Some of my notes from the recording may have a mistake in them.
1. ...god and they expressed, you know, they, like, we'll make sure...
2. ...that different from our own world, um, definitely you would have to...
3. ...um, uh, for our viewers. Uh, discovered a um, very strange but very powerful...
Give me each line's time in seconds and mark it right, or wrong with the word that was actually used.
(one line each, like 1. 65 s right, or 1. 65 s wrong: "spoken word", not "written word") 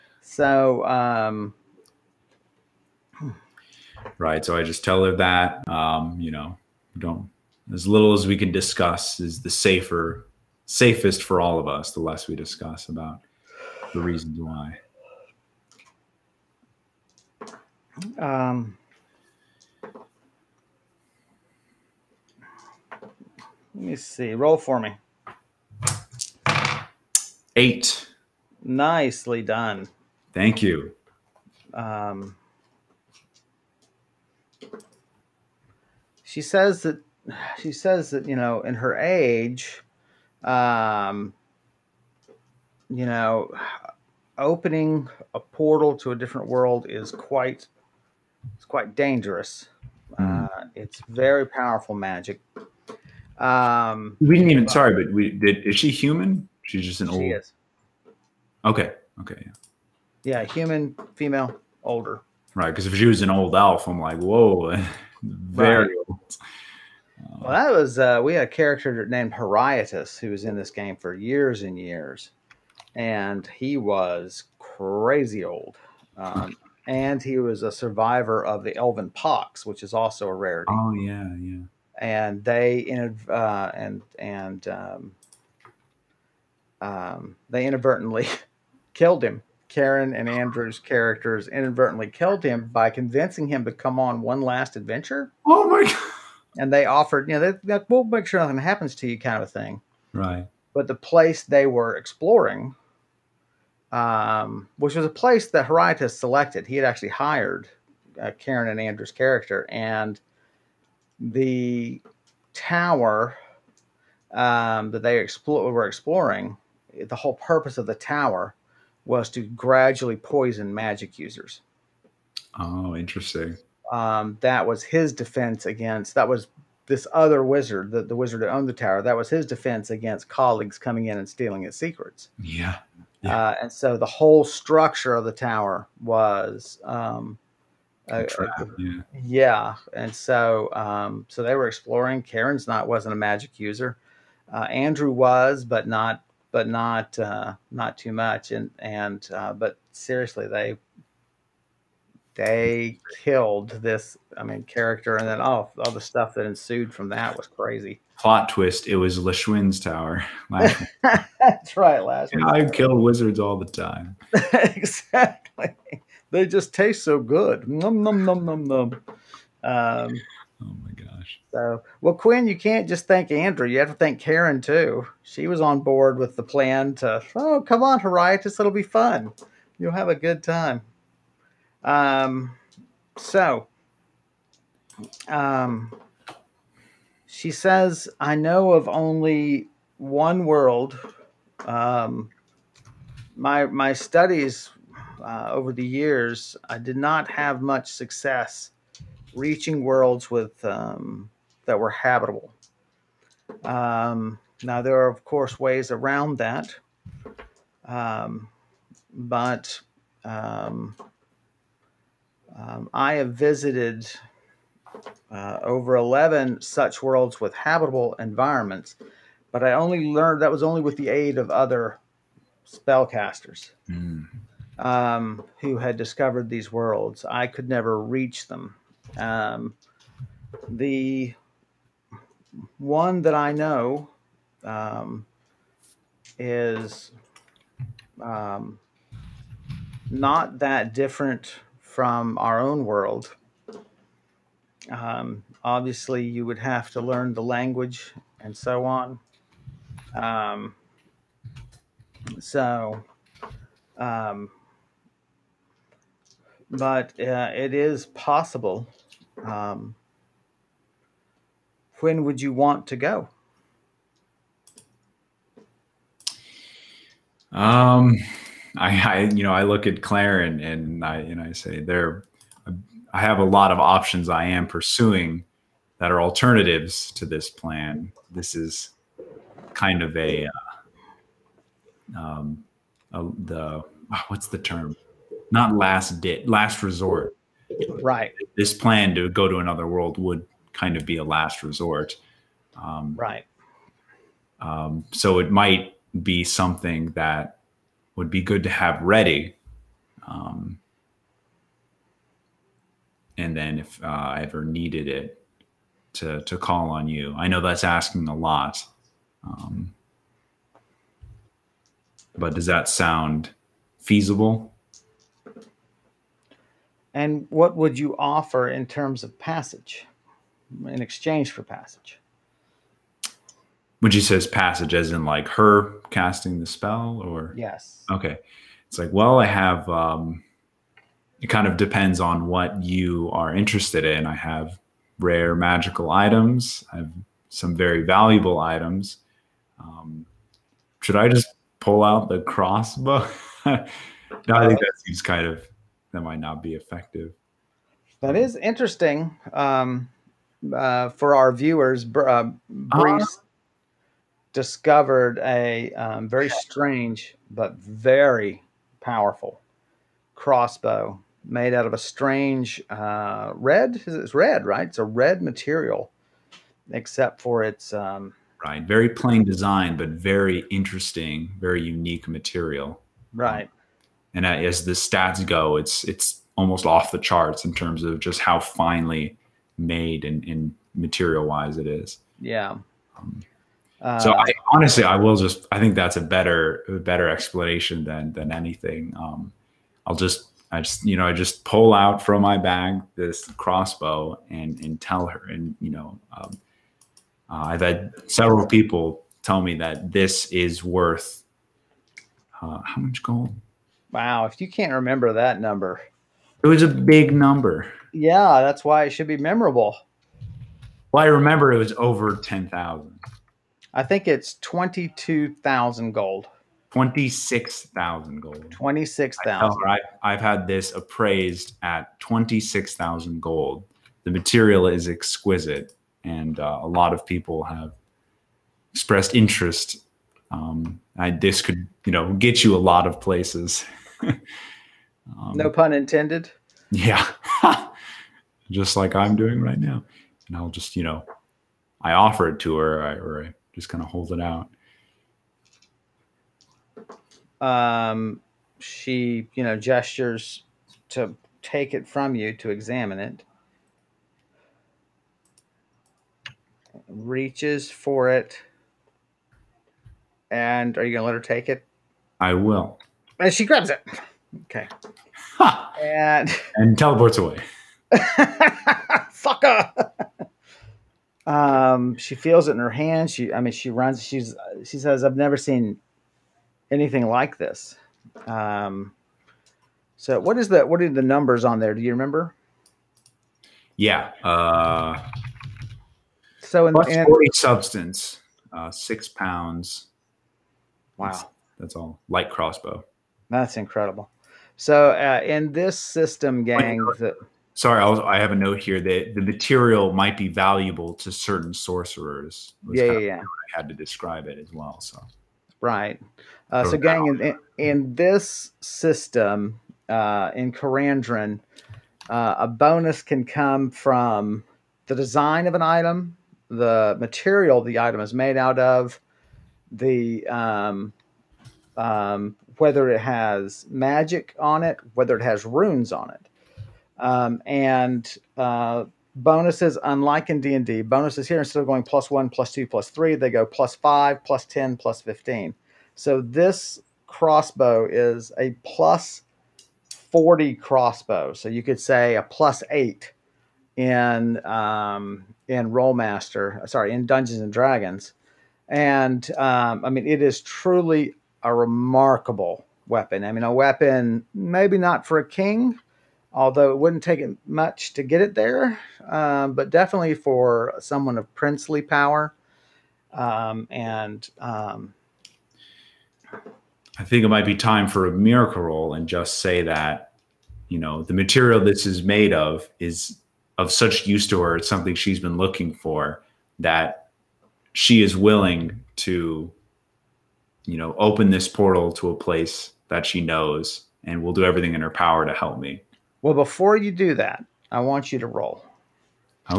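1. 95 s wrong: "offered", not "expressed"
2. 240 s wrong: "obviously", not "definitely"
3. 349 s right.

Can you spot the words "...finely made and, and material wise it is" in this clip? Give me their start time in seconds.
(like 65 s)
378 s.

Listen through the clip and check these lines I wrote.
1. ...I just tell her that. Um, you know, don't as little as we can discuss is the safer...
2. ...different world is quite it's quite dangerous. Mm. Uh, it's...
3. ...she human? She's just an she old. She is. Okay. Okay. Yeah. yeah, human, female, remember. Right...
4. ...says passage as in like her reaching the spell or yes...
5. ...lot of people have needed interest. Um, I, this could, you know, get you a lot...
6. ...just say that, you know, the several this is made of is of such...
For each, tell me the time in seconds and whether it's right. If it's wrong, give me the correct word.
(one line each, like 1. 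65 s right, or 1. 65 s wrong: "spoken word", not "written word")
1. 4 s right
2. 46 s right
3. 55 s wrong: "older", not "remember"
4. 324 s wrong: "casting", not "reaching"
5. 426 s wrong: "expressed", not "needed"
6. 569 s wrong: "material", not "several".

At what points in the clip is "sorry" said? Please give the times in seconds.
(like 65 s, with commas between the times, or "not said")
54 s, 497 s, 546 s.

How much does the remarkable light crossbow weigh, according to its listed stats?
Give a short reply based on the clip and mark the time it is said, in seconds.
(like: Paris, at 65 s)
6 pounds, at 488 s.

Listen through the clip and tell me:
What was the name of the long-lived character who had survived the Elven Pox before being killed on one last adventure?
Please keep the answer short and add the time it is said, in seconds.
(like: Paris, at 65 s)
Heriatus, at 69 s.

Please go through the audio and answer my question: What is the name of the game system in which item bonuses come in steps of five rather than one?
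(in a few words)
Karandrin.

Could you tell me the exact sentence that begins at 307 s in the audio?
I know that's asking a lot, um, but does that sound feasible?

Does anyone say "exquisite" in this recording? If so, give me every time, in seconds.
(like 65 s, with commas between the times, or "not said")
425 s.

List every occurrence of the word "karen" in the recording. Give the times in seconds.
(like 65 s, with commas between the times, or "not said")
89 s, 108 s, 142 s, 174 s.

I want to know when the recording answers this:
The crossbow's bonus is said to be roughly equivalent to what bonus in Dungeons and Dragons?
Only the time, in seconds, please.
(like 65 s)
542 s.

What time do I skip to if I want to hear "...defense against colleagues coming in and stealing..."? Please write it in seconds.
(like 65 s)
129 s.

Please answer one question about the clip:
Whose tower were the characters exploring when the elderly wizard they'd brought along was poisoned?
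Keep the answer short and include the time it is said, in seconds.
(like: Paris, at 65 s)
Lashwin, at 159 s.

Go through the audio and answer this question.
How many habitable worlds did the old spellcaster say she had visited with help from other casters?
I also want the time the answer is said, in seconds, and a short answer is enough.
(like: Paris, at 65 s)
Over 11, at 215 s.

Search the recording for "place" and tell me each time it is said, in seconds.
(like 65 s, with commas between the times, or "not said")
100 s, 105 s, 433 s, 582 s.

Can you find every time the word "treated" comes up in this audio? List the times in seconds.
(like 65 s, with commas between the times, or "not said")
not said.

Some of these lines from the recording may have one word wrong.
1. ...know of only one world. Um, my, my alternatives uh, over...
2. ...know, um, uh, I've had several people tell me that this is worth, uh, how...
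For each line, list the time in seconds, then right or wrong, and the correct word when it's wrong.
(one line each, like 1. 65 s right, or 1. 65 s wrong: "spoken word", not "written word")
1. 188 s wrong: "studies", not "alternatives"
2. 395 s right.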